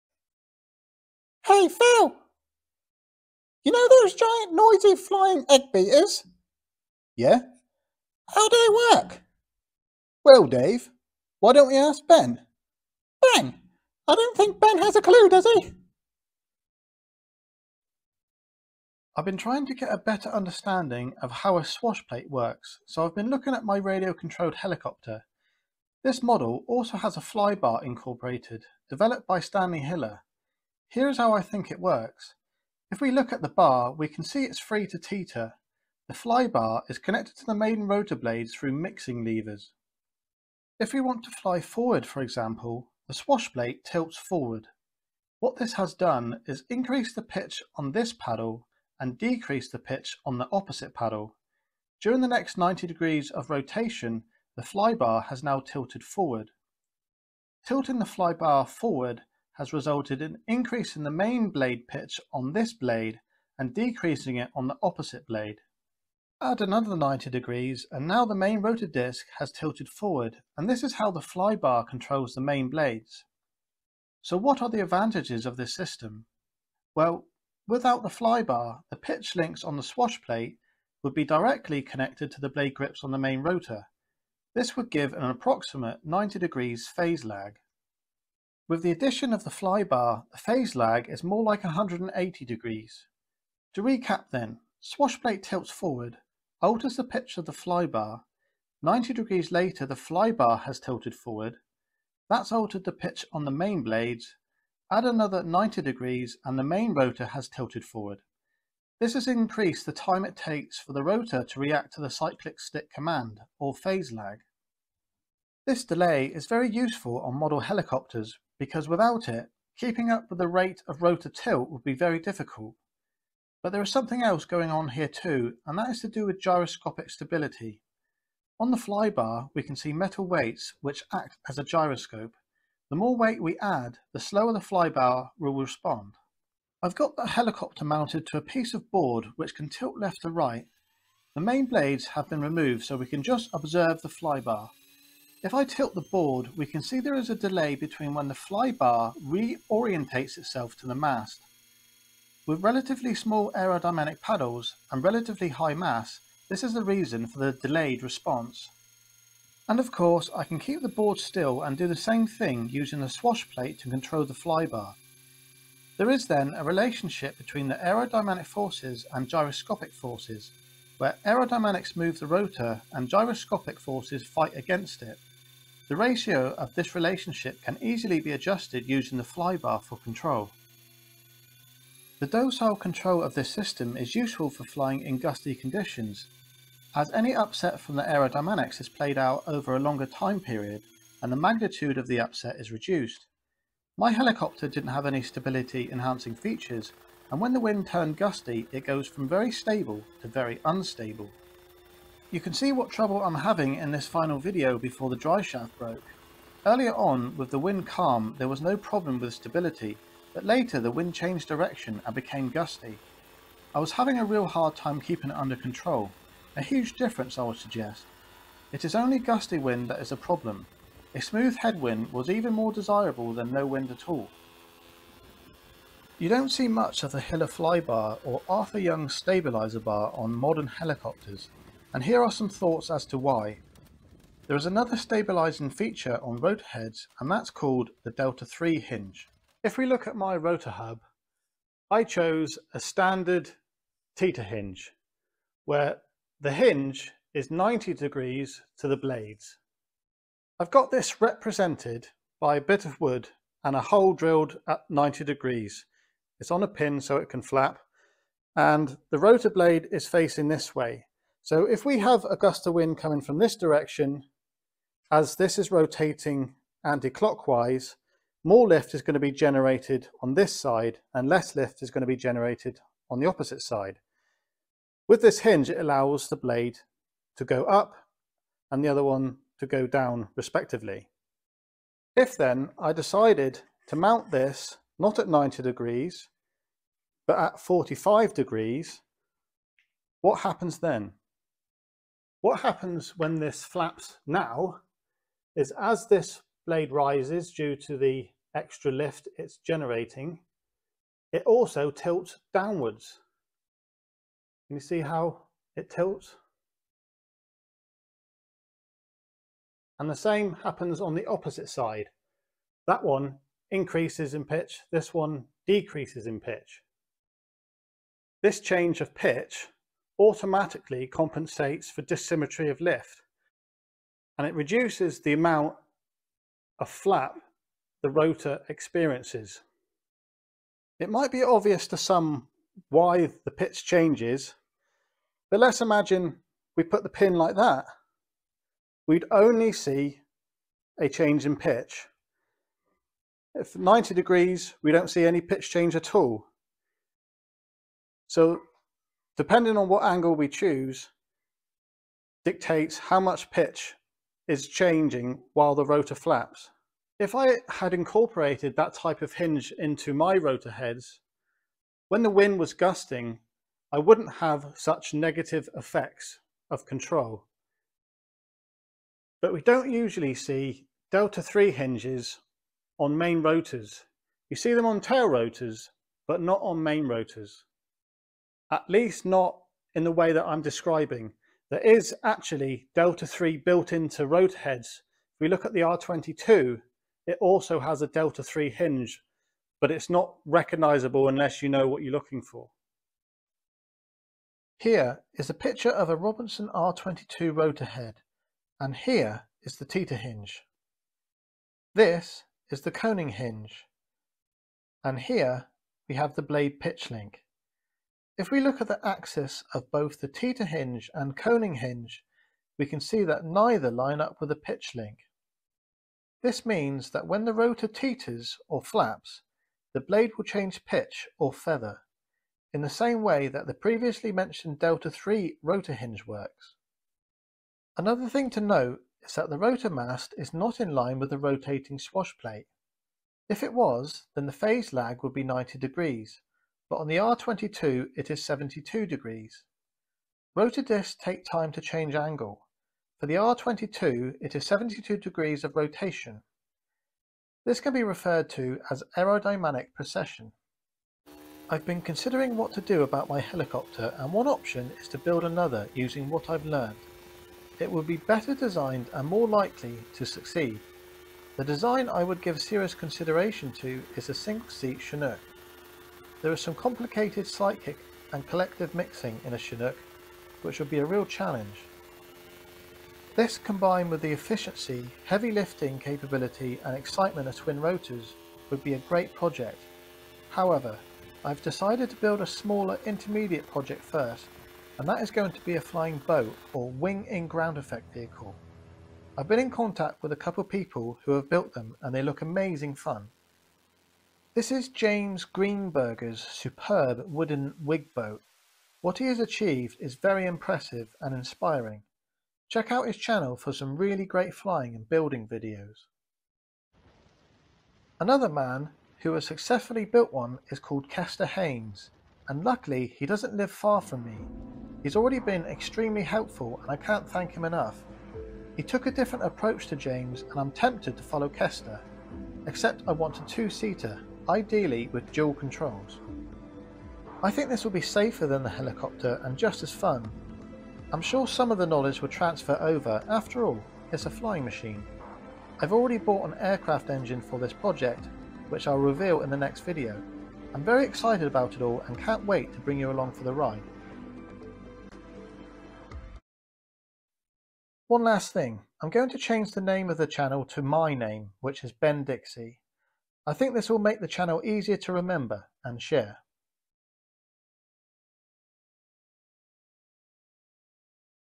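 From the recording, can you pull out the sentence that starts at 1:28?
With the addition of the flybar, the phase lag is more like 180 degrees.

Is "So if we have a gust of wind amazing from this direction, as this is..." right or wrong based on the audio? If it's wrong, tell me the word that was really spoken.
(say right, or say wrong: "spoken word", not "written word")
wrong: "coming", not "amazing".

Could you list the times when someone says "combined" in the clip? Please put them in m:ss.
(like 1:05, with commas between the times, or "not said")
7:53.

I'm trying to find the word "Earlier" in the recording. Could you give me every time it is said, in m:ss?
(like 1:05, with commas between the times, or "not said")
3:26.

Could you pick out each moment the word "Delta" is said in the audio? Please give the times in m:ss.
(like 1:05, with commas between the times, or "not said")
3:58, 6:11, 6:22, 6:28, 7:04.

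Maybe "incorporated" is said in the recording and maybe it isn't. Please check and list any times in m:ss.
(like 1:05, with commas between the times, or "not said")
0:27, 5:57.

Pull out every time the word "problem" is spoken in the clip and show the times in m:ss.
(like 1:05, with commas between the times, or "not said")
3:28, 3:40.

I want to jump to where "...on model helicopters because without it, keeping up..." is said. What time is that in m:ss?
1:57.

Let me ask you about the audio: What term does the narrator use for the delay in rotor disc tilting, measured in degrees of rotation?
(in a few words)
aerodynamic precession.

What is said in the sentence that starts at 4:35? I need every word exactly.
With this hinge, it allows the blade to go up and the other one to go down respectively.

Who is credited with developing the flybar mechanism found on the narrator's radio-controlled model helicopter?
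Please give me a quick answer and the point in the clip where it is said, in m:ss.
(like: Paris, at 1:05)
Stanley Hiller, at 0:29.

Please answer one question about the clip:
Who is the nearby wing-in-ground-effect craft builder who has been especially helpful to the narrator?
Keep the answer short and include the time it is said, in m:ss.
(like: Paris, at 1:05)
Kester Haynes, at 8:31.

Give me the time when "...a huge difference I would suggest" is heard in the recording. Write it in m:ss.
3:36.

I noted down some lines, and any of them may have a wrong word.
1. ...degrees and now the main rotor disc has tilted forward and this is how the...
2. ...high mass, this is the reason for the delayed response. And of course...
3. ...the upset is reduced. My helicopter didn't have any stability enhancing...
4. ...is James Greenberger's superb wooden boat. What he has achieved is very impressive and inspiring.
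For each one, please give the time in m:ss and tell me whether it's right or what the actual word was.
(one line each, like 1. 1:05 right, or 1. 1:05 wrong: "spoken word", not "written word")
1. 1:07 right
2. 2:35 right
3. 3:12 right
4. 8:14 right.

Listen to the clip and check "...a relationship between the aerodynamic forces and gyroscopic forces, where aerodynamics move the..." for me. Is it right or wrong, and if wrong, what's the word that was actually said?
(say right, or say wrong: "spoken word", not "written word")
right.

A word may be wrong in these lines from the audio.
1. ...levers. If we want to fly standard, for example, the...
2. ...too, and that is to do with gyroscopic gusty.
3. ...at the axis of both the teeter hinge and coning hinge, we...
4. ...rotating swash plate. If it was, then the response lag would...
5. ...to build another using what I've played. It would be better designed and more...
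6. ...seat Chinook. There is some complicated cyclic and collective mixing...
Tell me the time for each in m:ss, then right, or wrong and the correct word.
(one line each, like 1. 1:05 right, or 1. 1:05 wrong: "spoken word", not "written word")
1. 0:39 wrong: "forward", not "standard"
2. 2:05 wrong: "stability", not "gusty"
3. 6:48 right
4. 7:11 wrong: "phase", not "response"
5. 7:35 wrong: "learned", not "played"
6. 7:44 right.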